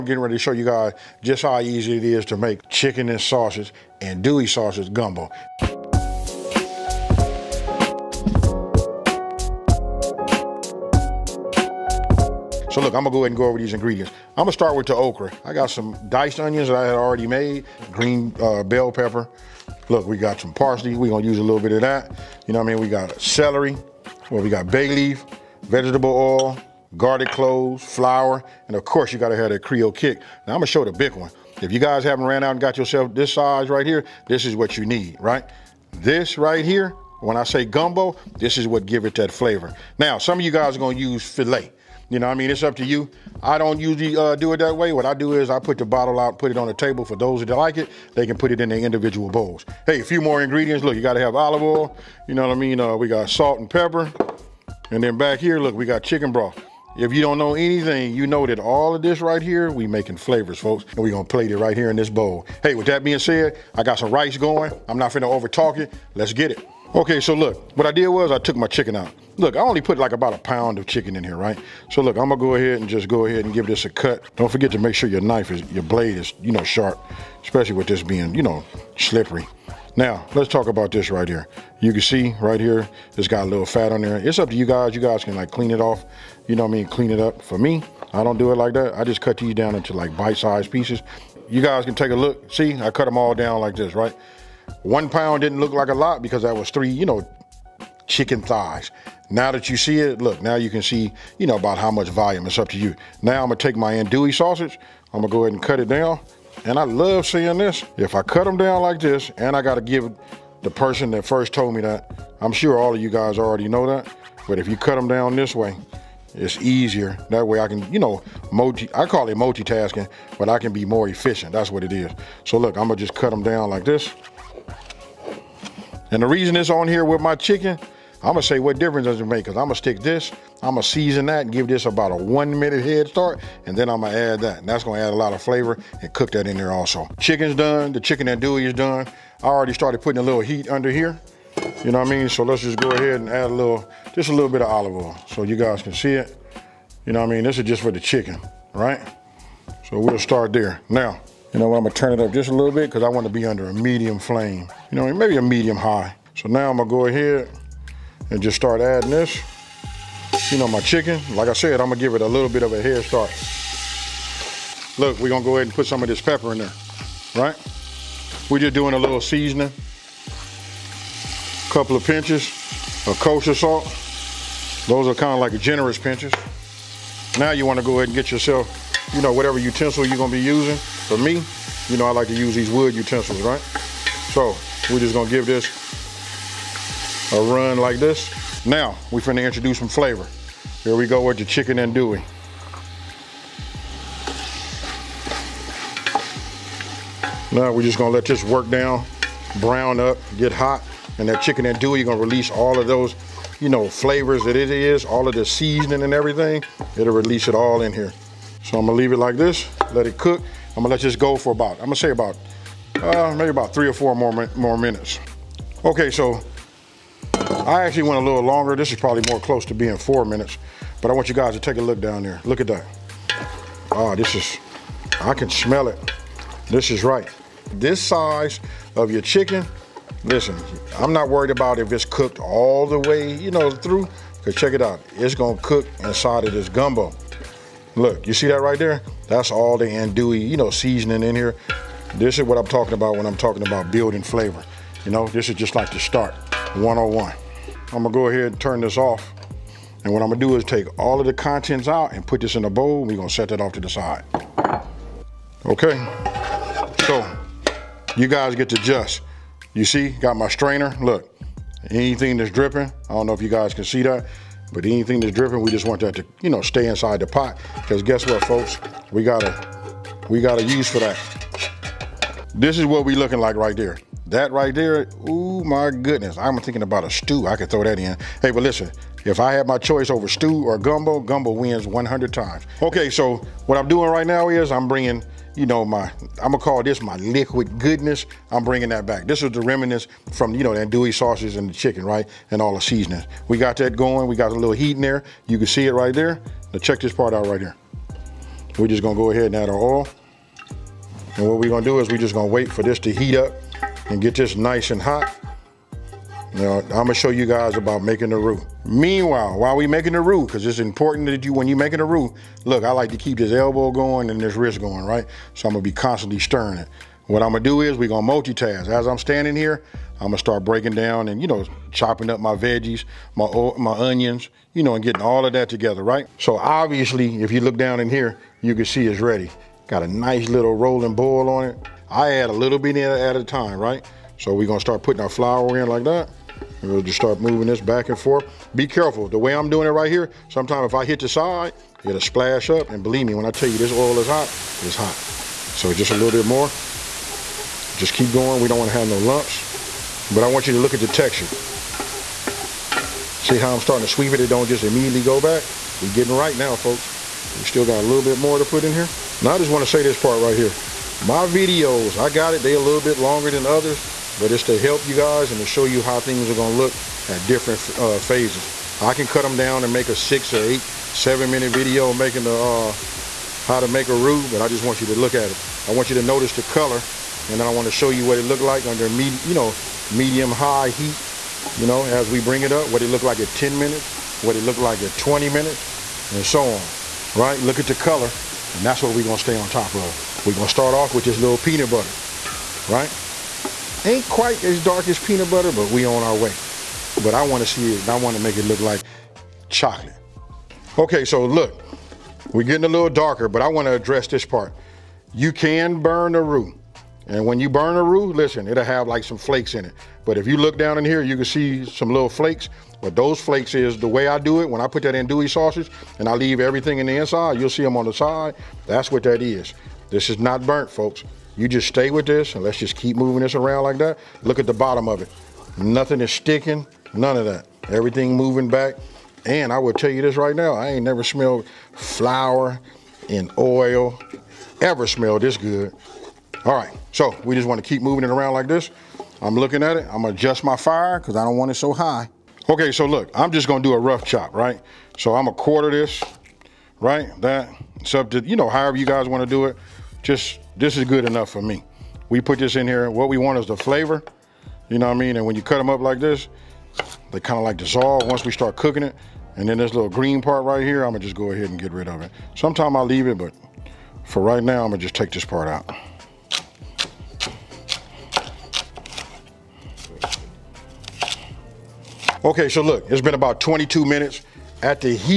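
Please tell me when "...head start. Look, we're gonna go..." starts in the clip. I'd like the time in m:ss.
2:42.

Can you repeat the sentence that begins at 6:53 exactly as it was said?
But those flakes is the way I do it.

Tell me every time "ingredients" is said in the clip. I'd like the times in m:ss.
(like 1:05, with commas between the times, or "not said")
0:13, 0:50.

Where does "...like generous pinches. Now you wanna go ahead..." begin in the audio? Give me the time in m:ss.
2:55.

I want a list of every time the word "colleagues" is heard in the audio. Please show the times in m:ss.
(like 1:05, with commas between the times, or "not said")
not said.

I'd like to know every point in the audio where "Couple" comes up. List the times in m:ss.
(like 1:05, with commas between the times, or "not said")
2:51.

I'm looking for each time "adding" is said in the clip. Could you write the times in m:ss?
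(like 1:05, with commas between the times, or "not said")
2:38.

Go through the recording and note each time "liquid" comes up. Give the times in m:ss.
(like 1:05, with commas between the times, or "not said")
4:47.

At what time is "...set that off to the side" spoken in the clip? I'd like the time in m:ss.
4:13.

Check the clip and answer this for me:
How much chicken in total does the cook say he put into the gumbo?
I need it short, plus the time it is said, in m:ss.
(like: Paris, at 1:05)
1 pound, at 1:10.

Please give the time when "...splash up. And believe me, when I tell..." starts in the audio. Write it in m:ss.
5:42.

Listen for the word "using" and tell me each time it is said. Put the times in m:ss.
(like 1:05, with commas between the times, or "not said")
3:00.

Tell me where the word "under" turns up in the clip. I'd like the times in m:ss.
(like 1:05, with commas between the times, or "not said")
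2:20, 2:33, 6:18.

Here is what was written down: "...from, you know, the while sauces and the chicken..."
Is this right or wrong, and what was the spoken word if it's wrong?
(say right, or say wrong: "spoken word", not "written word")
wrong: "andouille", not "while".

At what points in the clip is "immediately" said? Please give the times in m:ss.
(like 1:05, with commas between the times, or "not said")
5:54.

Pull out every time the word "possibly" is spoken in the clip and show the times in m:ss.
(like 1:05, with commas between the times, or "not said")
not said.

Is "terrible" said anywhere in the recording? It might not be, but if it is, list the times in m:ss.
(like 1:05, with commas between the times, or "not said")
not said.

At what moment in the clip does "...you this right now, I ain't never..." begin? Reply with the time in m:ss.
7:10.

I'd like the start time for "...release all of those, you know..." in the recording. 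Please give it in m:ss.
3:22.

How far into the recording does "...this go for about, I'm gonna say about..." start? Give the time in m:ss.
3:31.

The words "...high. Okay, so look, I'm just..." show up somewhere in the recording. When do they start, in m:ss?
7:21.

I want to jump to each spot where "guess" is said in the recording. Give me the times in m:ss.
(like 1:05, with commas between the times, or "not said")
4:28.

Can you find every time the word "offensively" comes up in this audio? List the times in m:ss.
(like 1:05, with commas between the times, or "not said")
not said.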